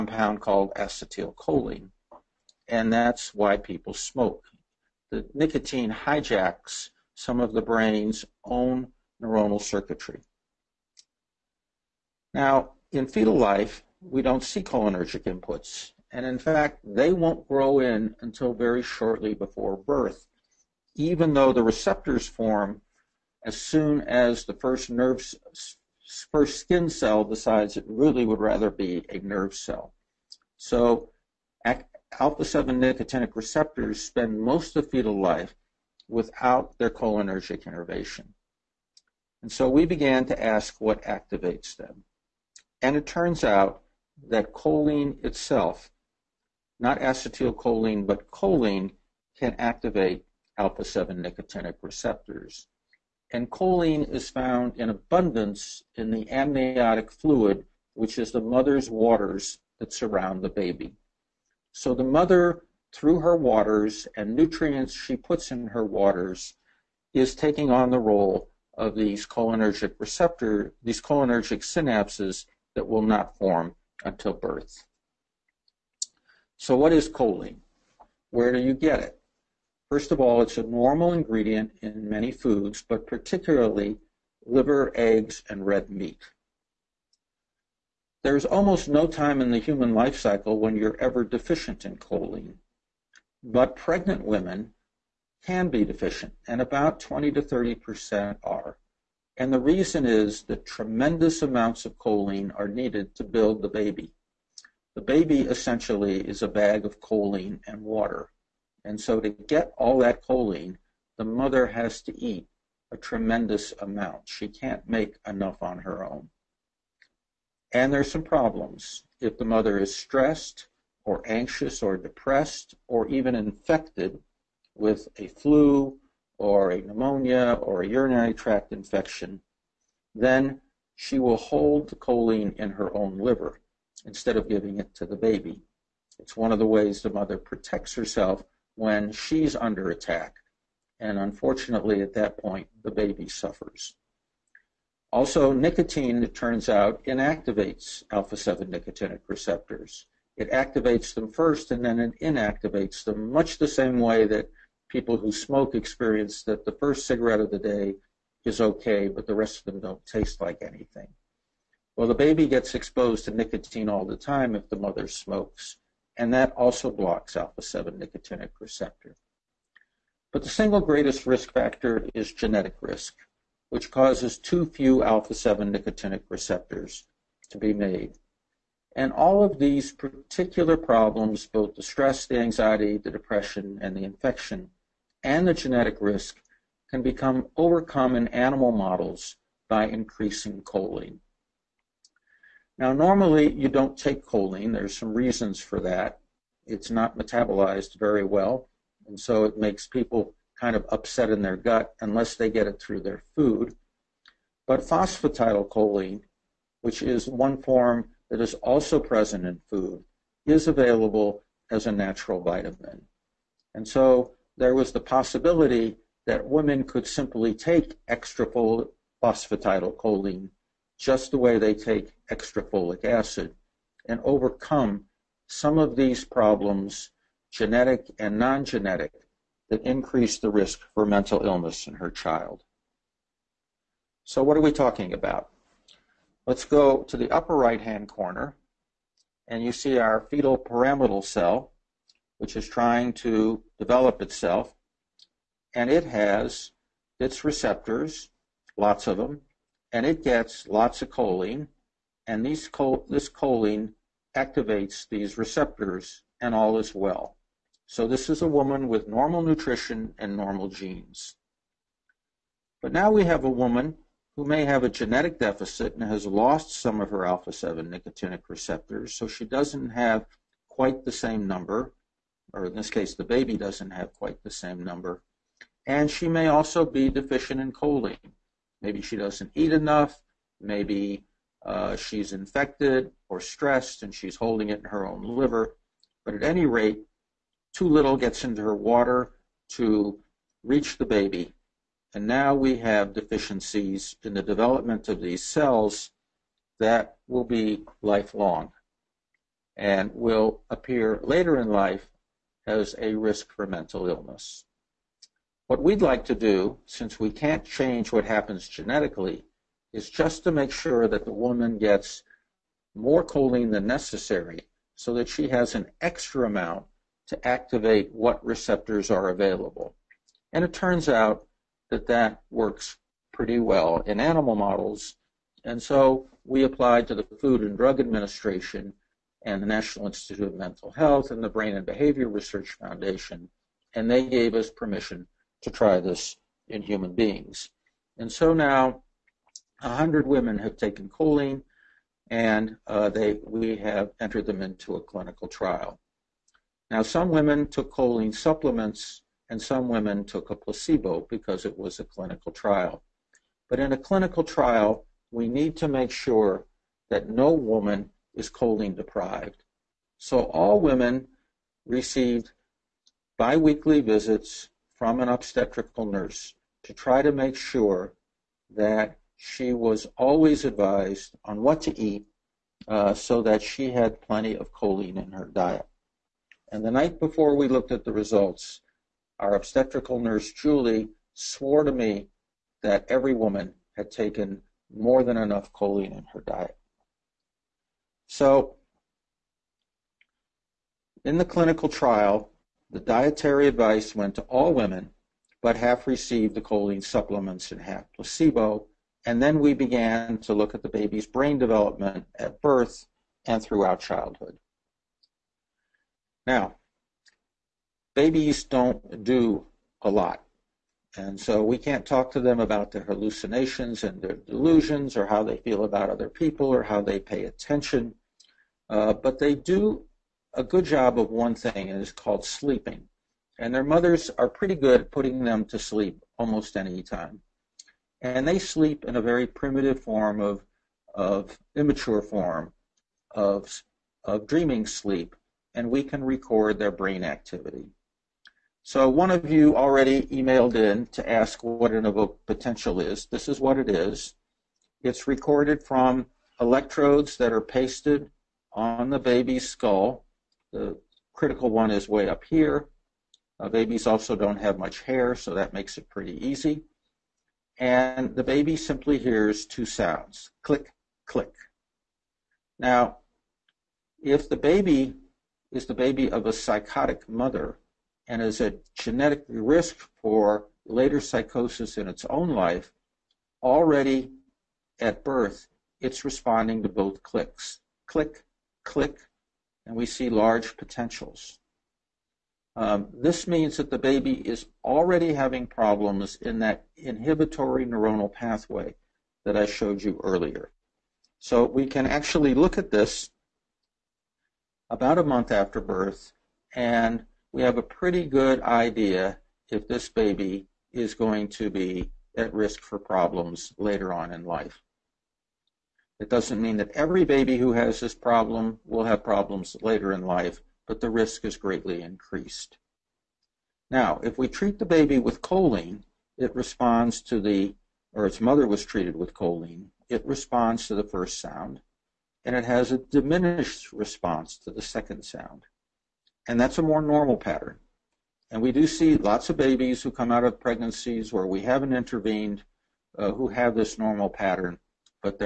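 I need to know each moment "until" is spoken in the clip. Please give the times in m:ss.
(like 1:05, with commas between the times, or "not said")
0:18, 1:14.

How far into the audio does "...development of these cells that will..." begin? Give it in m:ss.
4:54.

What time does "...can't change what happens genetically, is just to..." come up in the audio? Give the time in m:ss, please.
5:07.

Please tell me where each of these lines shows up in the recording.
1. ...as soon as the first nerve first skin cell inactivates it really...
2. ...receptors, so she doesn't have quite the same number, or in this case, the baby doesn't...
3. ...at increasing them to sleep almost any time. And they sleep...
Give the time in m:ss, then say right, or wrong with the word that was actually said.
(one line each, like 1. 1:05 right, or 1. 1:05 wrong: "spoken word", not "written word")
1. 0:23 wrong: "decides", not "inactivates"
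2. 4:28 right
3. 7:05 wrong: "putting", not "increasing".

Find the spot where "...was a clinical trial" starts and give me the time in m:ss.
5:51.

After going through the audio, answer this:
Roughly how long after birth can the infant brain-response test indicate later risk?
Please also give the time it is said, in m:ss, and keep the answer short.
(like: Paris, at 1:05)
about a month, at 8:14.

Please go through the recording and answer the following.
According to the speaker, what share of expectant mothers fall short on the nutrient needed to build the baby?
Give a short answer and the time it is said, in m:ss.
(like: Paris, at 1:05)
20 to 30 percent, at 1:37.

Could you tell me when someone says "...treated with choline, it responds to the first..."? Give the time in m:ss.
8:38.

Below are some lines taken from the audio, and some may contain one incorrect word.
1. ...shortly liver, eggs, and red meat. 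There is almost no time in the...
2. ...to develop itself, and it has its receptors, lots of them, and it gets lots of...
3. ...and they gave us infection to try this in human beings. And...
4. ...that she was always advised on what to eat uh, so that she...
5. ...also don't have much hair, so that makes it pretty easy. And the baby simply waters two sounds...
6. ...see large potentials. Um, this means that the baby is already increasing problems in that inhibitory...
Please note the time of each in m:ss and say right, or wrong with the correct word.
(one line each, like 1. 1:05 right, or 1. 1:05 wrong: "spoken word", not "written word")
1. 1:23 wrong: "particularly", not "shortly"
2. 4:03 right
3. 5:33 wrong: "permission", not "infection"
4. 6:08 right
5. 7:34 wrong: "hears", not "waters"
6. 8:00 wrong: "having", not "increasing".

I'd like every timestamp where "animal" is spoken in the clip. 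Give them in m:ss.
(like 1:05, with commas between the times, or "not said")
3:08, 5:24.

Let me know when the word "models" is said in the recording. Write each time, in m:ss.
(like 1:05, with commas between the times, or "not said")
3:08, 5:24.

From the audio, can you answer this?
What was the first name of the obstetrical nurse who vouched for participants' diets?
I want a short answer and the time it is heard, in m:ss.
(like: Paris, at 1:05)
Julie, at 6:20.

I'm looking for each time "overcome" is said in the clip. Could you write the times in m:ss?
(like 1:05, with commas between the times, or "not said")
3:07, 3:44.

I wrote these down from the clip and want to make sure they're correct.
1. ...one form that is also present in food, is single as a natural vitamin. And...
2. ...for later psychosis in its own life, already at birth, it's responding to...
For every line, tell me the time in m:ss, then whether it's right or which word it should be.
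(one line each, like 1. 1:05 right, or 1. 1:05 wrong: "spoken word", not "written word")
1. 3:27 wrong: "available", not "single"
2. 7:50 right.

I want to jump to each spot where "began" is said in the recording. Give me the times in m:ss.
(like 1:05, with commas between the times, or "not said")
0:39, 6:39.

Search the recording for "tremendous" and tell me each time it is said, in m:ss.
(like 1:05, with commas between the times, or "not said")
1:40, 1:52.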